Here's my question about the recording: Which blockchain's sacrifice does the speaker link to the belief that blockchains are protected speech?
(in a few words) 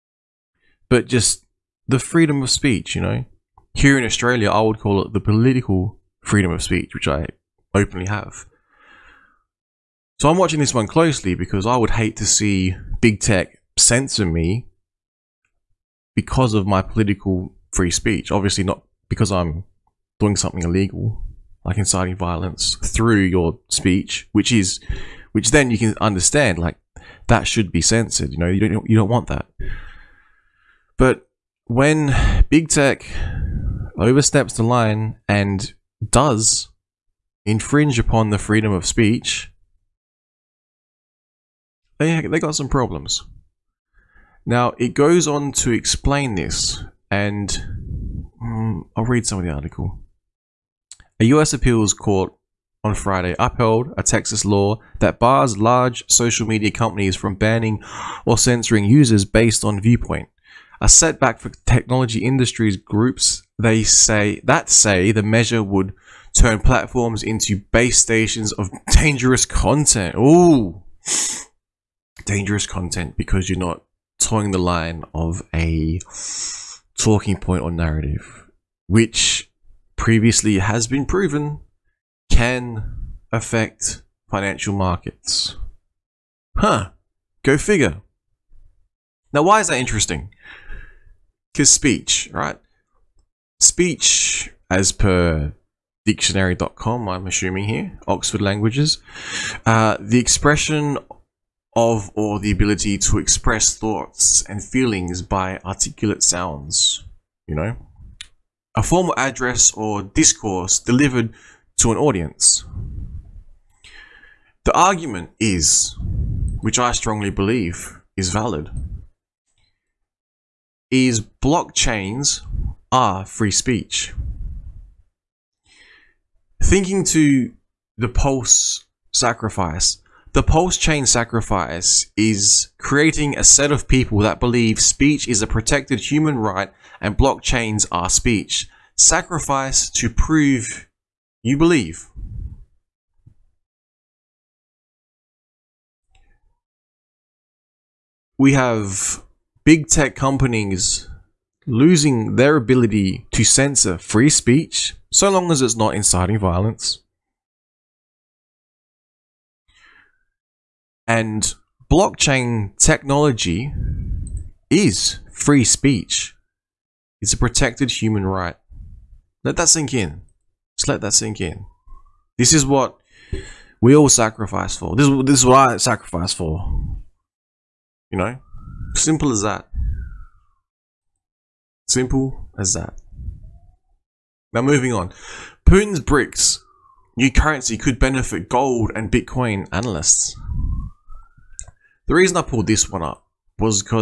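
PulseChain.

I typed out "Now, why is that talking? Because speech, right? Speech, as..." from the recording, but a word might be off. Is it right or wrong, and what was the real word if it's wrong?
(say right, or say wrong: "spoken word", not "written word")
wrong: "interesting", not "talking".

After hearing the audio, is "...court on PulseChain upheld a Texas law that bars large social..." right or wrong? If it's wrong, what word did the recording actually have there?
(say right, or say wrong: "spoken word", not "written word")
wrong: "Friday", not "PulseChain".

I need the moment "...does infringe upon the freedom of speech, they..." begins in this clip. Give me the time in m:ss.
0:36.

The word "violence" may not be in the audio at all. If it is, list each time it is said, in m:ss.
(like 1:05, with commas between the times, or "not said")
0:22, 2:36.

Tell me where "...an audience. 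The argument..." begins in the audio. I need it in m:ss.
1:51.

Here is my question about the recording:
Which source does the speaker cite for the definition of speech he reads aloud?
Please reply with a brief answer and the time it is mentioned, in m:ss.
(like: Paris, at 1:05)
Oxford Languages, at 1:38.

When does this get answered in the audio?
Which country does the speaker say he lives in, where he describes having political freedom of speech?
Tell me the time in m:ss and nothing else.
0:04.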